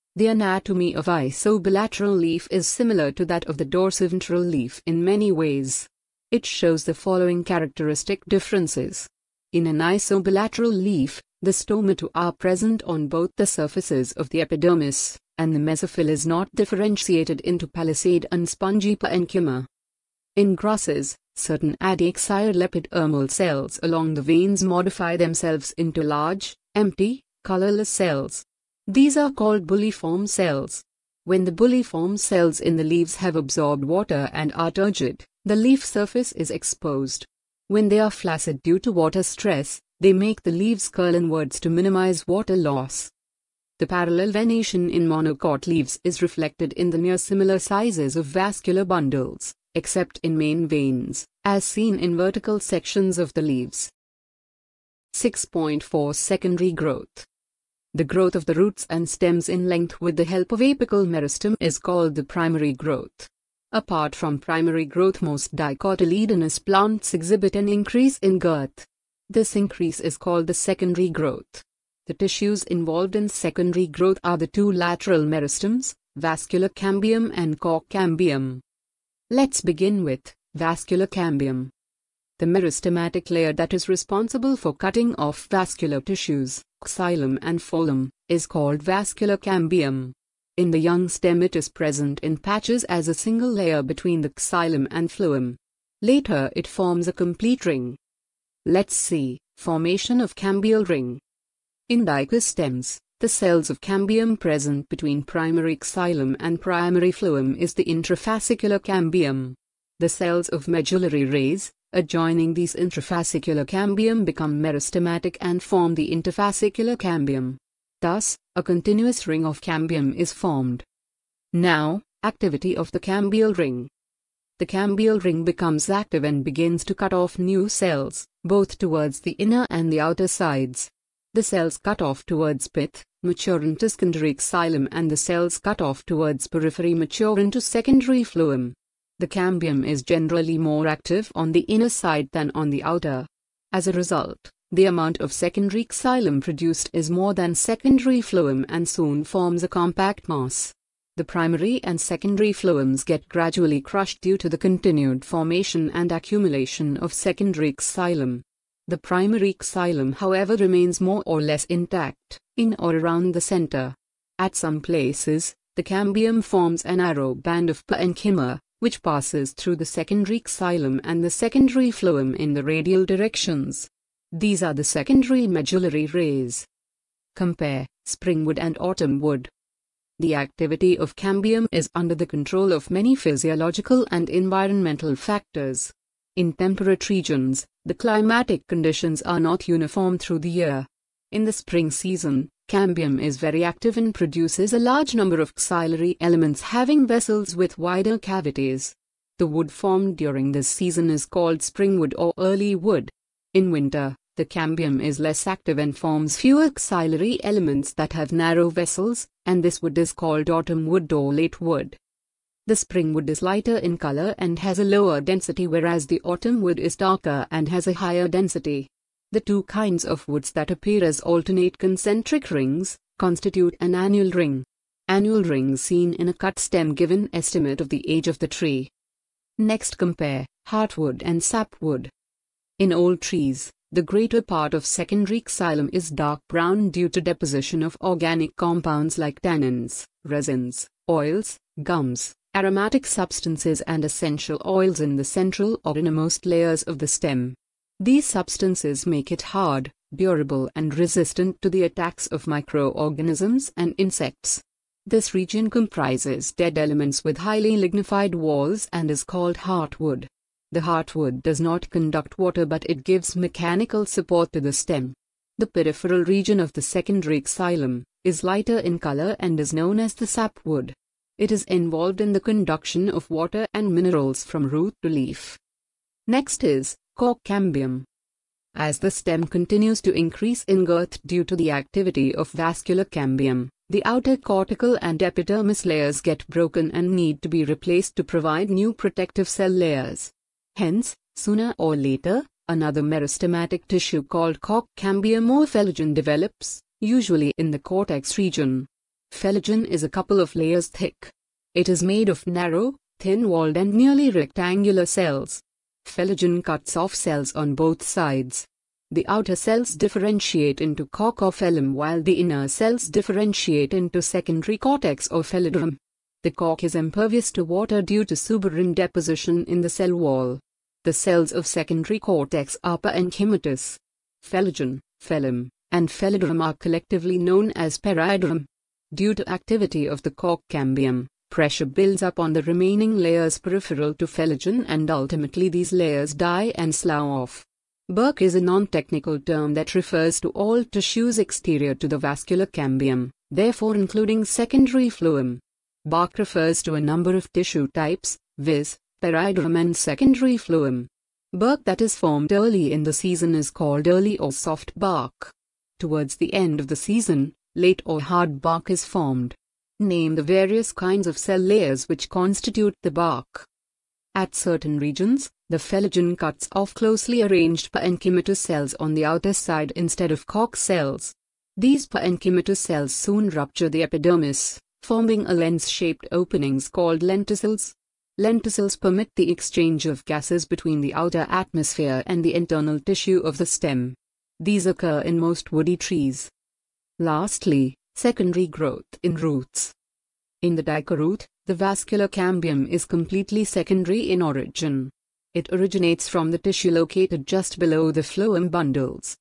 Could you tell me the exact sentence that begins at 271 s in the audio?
It is involved in the conduction of water and minerals from root to leaf.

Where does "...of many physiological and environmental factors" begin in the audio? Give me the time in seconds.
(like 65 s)
182 s.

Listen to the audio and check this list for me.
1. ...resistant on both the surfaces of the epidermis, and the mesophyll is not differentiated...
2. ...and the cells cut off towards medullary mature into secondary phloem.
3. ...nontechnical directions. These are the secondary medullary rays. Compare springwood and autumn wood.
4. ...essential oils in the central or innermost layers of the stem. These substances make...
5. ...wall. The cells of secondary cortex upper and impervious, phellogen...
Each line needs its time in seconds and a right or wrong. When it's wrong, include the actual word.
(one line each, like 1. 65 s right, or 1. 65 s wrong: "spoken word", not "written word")
1. 12 s wrong: "present", not "resistant"
2. 134 s wrong: "periphery", not "medullary"
3. 172 s wrong: "radial", not "nontechnical"
4. 244 s right
5. 320 s wrong: "enchymatous", not "impervious".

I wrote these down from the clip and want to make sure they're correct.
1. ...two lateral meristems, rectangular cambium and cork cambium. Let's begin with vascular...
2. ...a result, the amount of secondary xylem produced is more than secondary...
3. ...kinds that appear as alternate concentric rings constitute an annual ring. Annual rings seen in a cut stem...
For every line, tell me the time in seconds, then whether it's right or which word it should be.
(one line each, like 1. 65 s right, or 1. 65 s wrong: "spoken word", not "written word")
1. 74 s wrong: "vascular", not "rectangular"
2. 143 s right
3. 220 s wrong: "woods", not "kinds".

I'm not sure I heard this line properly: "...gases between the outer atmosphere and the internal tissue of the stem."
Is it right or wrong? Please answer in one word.
right.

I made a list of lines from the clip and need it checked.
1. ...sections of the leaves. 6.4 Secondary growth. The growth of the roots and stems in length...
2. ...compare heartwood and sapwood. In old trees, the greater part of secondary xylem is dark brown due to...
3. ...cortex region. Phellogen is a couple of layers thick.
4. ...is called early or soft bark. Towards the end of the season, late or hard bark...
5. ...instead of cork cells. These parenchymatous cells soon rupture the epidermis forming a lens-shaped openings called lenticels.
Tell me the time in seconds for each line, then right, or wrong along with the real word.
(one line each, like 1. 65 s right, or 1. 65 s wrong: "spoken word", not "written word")
1. 52 s right
2. 229 s right
3. 297 s right
4. 353 s right
5. 369 s right.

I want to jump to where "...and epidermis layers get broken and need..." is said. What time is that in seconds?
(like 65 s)
285 s.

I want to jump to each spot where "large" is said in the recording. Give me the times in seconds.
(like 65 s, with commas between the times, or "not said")
26 s, 194 s.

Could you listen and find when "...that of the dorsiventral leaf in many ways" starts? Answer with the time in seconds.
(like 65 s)
3 s.